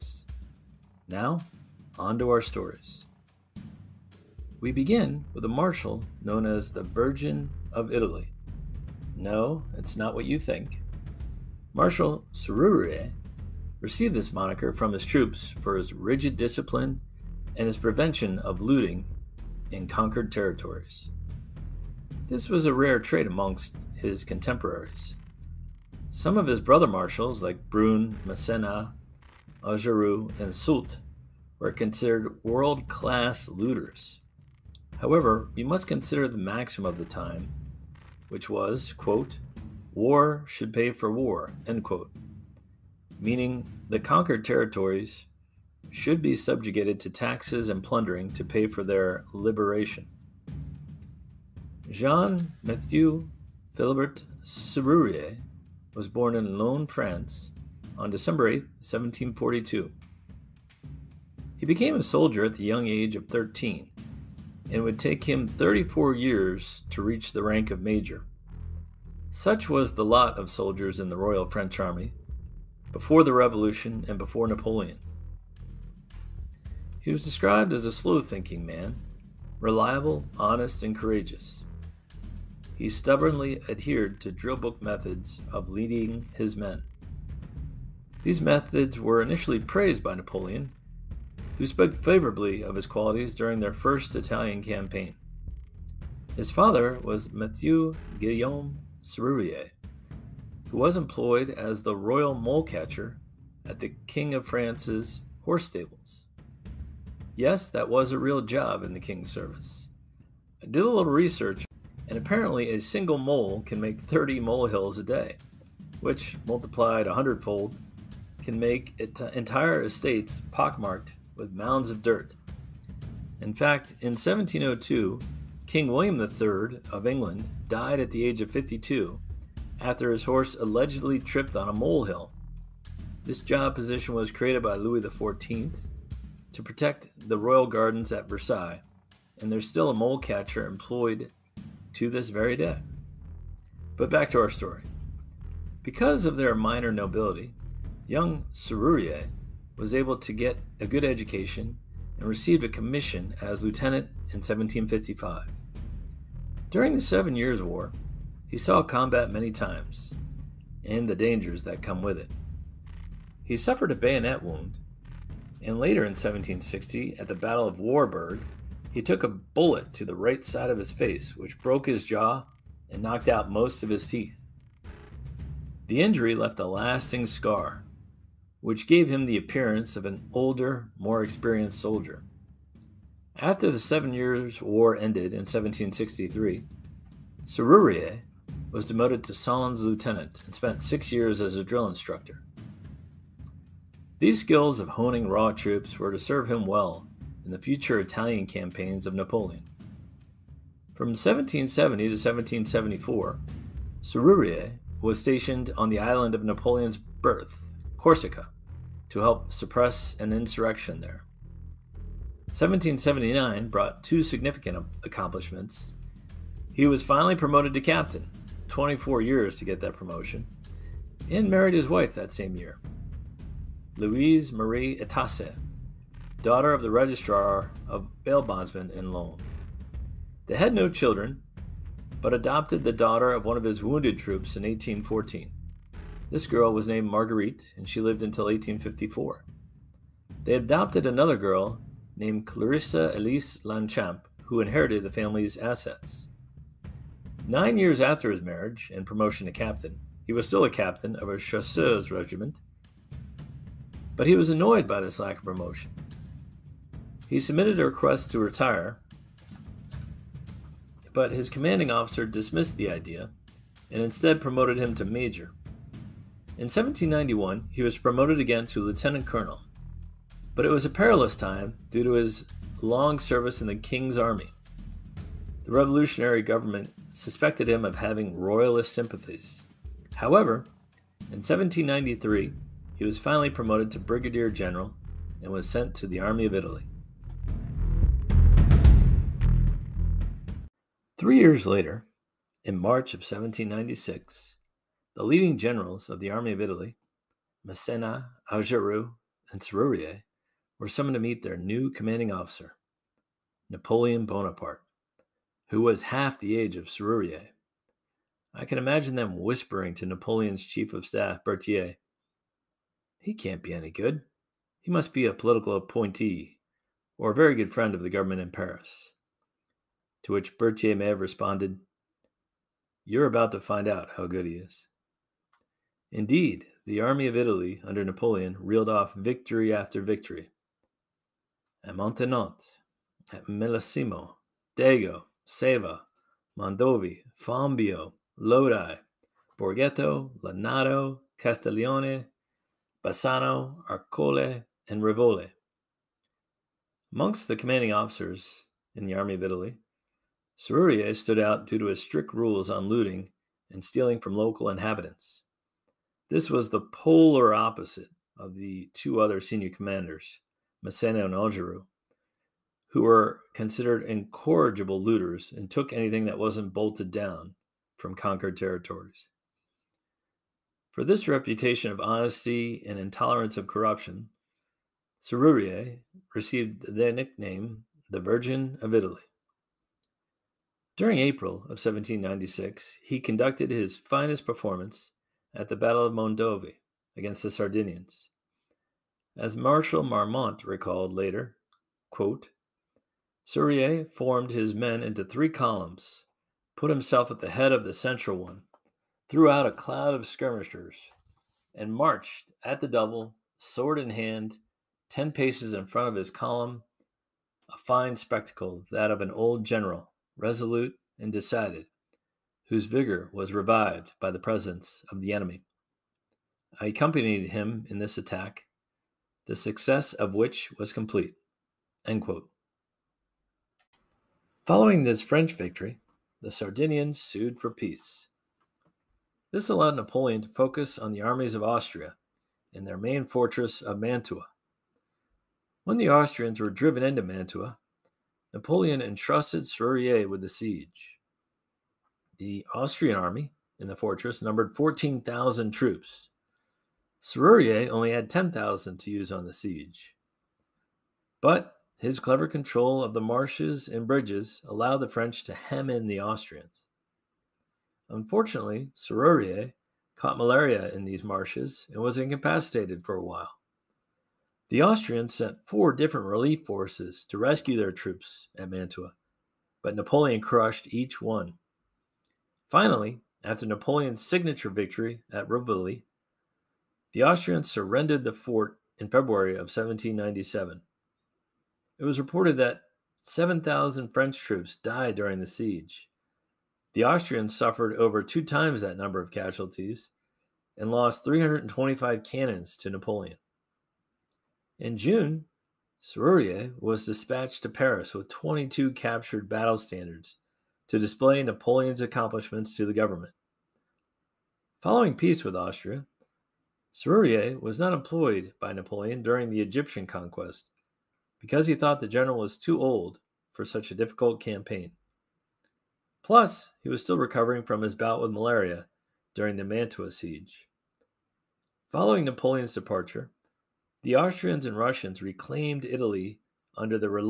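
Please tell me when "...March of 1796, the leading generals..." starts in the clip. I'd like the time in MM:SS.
04:52.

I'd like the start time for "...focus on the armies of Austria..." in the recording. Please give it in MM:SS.
07:10.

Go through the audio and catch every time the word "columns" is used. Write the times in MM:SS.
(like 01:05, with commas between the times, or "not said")
06:35, 06:46.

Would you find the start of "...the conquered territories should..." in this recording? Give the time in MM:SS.
00:43.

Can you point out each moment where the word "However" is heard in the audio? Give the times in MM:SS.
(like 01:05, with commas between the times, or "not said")
00:34, 04:40.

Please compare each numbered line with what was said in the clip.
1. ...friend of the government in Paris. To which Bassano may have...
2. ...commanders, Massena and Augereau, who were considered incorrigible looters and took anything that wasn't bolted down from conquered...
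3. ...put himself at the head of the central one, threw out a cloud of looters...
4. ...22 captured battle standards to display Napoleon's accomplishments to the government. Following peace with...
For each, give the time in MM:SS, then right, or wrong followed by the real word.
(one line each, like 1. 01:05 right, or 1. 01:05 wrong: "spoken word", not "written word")
1. 05:17 wrong: "Berthier", not "Bassano"
2. 05:59 right
3. 06:36 wrong: "skirmishers", not "looters"
4. 08:18 right.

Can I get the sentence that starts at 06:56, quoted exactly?
I accompanied him in this attack, the success of which was complete.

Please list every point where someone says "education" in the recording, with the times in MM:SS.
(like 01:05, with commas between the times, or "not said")
02:31.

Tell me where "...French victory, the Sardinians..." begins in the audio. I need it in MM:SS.
07:05.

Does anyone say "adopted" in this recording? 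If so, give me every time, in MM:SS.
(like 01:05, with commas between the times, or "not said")
03:52, 04:00.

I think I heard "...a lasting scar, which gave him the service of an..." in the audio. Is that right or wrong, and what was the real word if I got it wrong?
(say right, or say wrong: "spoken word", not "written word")
wrong: "appearance", not "service".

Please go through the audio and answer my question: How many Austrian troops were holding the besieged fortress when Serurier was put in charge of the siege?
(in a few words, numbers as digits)
14,000.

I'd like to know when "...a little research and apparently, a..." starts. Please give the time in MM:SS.
01:50.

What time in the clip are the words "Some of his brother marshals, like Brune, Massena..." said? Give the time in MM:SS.
00:26.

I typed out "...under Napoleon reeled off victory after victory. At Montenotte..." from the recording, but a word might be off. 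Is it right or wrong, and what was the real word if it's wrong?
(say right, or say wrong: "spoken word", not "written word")
right.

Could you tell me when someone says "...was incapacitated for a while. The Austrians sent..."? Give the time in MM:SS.
07:42.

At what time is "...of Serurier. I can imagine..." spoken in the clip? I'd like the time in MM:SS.
05:06.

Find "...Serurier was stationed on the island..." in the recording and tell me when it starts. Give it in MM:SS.
03:24.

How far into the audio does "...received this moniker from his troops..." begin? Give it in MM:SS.
00:13.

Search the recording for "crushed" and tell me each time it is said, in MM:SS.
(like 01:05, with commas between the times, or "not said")
07:50.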